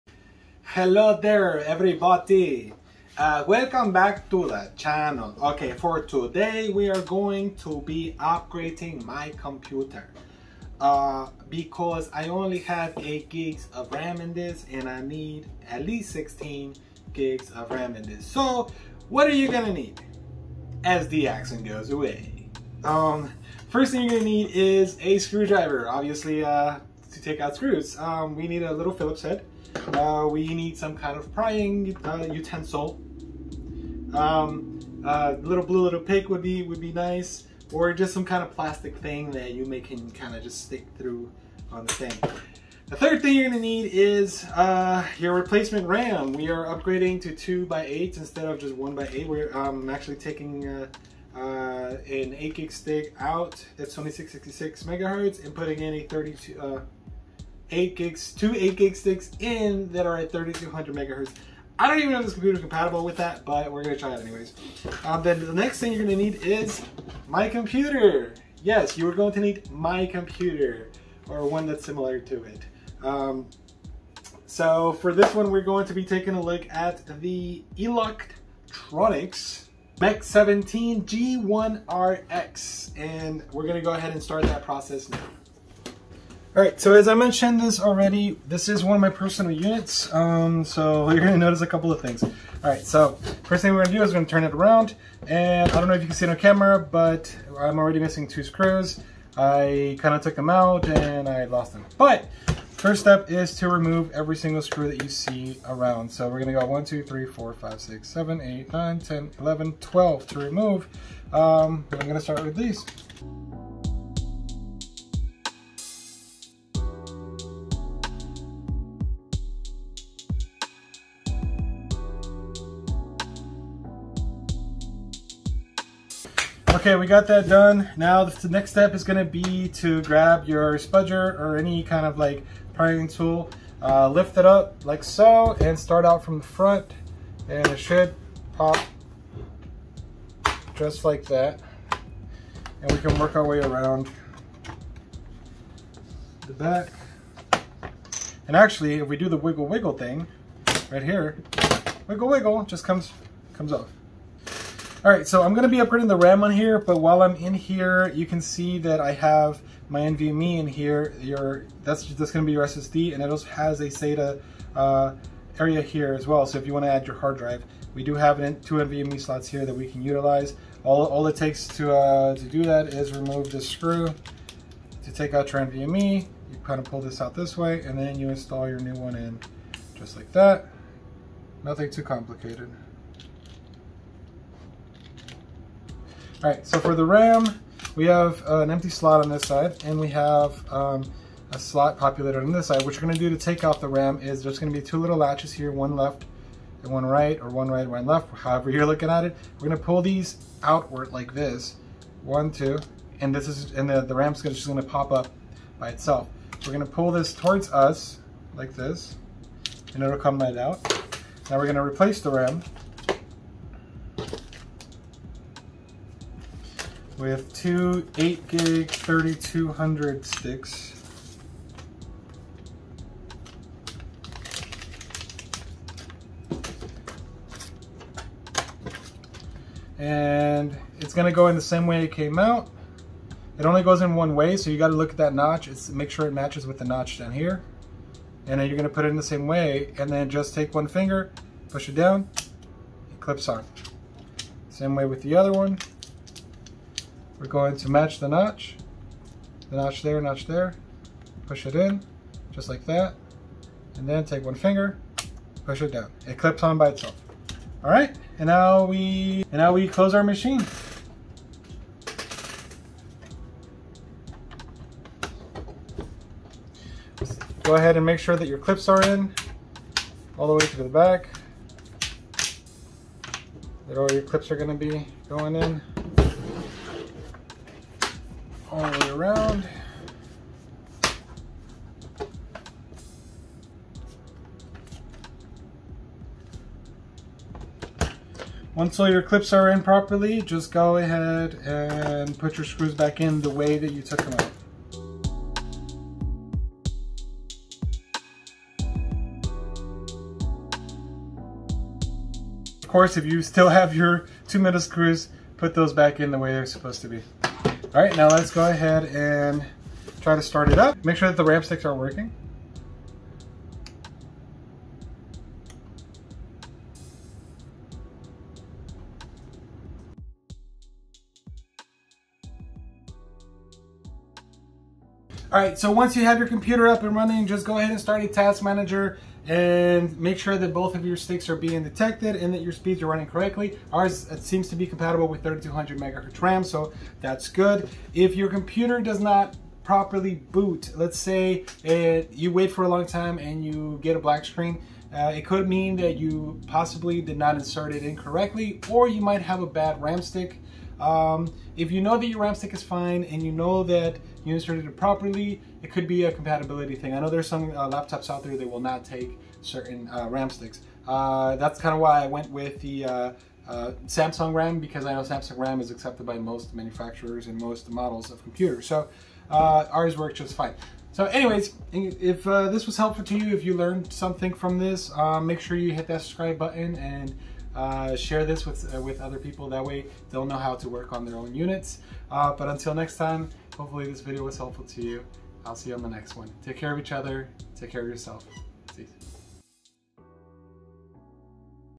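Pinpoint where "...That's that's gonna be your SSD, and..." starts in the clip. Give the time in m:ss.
2:41.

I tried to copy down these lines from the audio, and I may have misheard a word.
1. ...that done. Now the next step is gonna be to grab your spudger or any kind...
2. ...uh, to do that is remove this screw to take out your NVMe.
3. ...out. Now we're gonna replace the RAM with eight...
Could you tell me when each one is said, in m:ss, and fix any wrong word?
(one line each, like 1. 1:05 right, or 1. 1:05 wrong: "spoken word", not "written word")
1. 2:07 right
2. 2:51 right
3. 3:30 wrong: "two", not "eight".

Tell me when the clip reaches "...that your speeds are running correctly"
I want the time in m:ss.
5:32.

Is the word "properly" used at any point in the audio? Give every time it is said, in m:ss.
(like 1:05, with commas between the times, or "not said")
4:49, 5:39, 5:54.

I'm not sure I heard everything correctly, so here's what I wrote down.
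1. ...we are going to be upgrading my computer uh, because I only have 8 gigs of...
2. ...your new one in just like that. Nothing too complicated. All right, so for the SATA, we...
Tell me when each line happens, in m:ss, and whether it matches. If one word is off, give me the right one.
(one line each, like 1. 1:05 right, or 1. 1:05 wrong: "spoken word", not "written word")
1. 0:06 right
2. 2:58 wrong: "RAM", not "SATA".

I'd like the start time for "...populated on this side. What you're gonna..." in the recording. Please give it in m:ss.
3:11.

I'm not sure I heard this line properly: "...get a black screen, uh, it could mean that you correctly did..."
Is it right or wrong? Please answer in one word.
wrong.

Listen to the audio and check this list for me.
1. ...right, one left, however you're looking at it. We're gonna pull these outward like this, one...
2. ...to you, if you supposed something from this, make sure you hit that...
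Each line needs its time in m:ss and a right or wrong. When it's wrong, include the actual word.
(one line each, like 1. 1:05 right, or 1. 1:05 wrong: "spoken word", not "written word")
1. 3:17 right
2. 6:13 wrong: "learned", not "supposed".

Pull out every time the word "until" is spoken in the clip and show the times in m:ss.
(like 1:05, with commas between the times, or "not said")
6:22.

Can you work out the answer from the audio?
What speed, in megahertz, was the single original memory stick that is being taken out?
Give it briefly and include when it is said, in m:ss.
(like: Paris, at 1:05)
2666, at 0:53.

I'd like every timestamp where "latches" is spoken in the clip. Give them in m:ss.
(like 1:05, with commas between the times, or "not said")
3:15.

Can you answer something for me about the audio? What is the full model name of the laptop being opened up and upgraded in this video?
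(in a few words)
Eluktronics Mech 17 G1RX.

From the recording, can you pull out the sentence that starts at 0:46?
We are upgrading to two by eight instead of just one by eight.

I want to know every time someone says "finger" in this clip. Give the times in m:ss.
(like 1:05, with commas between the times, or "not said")
4:00, 4:14.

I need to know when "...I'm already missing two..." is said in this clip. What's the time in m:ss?
1:37.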